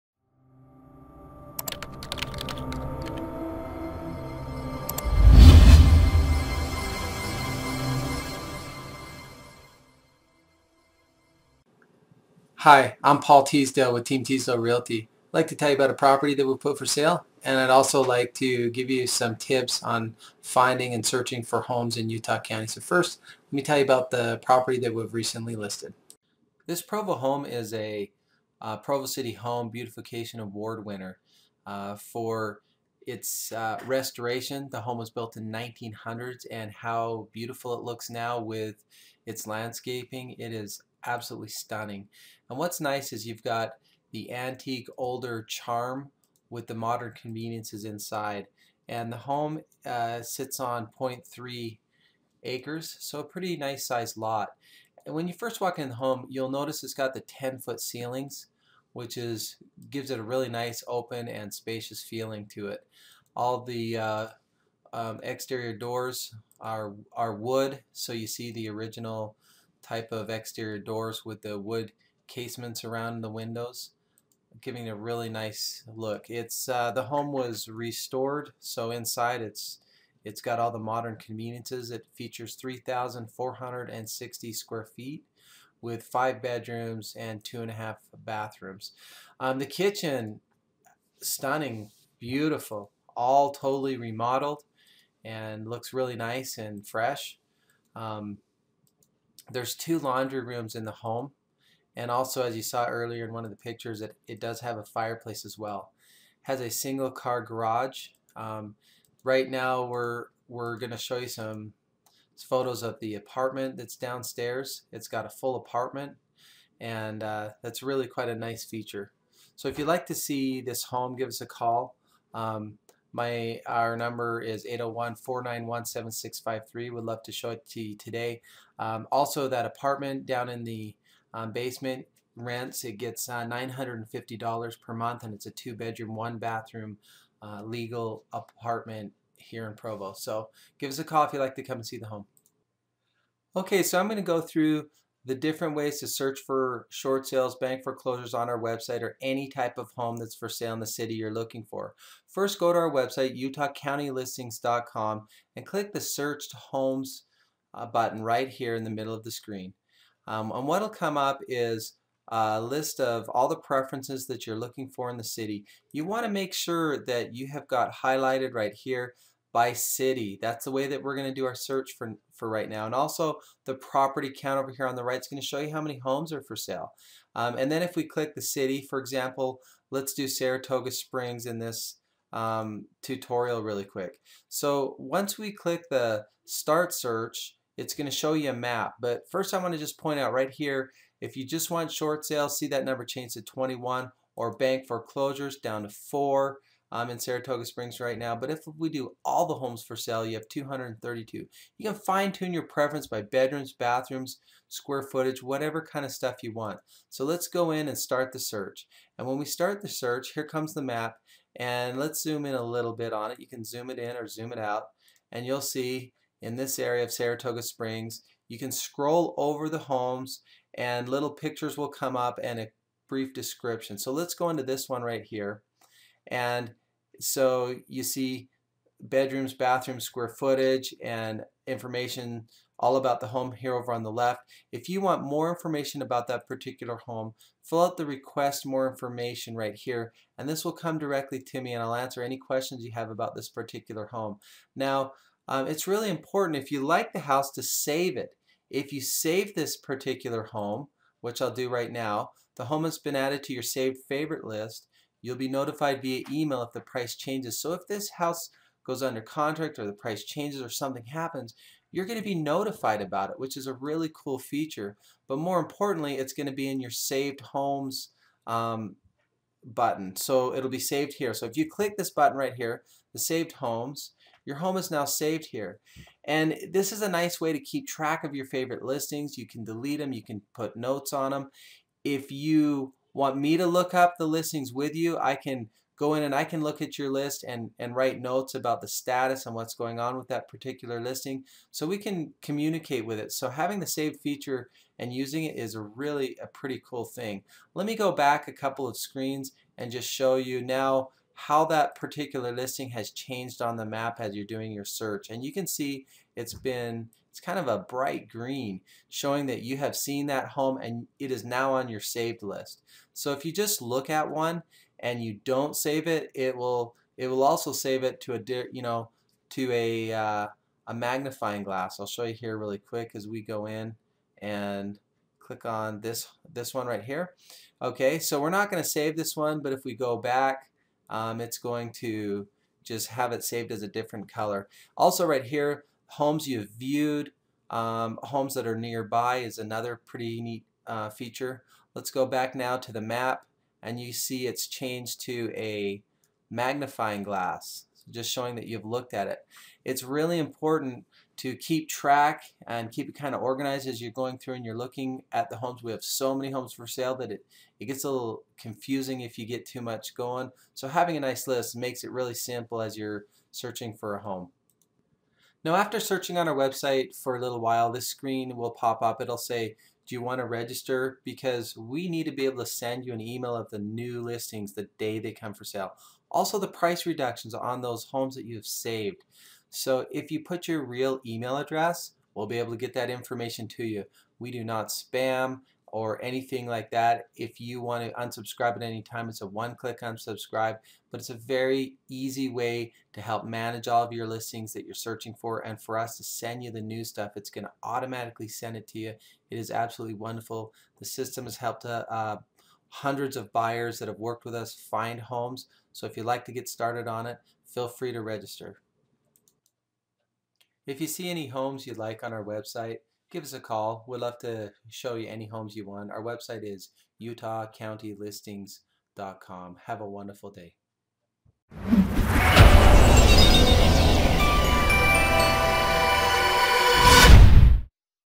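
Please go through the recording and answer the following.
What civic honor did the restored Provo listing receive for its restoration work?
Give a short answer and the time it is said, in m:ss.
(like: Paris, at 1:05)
Provo City Home Beautification Award, at 0:28.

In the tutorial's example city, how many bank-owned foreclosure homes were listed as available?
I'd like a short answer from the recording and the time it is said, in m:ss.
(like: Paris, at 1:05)
4, at 3:15.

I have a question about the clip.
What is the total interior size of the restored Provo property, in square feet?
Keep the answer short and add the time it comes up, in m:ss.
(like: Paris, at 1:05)
3,460, at 1:22.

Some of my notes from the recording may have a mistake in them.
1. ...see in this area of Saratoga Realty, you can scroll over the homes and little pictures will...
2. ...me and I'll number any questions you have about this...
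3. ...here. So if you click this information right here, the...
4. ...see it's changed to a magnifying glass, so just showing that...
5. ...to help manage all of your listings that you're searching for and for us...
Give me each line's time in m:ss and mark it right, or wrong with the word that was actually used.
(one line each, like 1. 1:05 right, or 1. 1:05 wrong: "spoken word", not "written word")
1. 3:35 wrong: "Springs", not "Realty"
2. 4:01 wrong: "answer", not "number"
3. 4:31 wrong: "button", not "information"
4. 5:44 right
5. 6:33 right.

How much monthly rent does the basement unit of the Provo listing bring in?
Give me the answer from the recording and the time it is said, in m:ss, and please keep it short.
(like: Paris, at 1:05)
$950, at 2:13.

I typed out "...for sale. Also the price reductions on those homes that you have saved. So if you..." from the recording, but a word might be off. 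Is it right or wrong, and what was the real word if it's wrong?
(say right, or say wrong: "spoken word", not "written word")
right.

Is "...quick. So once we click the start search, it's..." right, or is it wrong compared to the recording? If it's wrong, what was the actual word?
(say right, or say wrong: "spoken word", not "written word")
right.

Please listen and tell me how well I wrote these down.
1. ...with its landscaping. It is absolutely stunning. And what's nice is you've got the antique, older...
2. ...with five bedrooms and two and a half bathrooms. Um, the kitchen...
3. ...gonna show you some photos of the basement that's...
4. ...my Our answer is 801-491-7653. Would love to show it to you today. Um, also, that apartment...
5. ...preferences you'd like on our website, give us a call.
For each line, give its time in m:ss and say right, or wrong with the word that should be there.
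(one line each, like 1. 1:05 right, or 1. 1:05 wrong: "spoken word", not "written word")
1. 0:38 right
2. 1:25 right
3. 1:50 wrong: "apartment", not "basement"
4. 2:03 wrong: "number", not "answer"
5. 6:51 wrong: "homes", not "preferences".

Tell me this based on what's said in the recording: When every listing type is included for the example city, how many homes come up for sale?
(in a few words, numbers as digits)
232.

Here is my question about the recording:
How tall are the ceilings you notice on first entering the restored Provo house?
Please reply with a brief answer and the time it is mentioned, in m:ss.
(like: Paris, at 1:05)
10 foot, at 0:57.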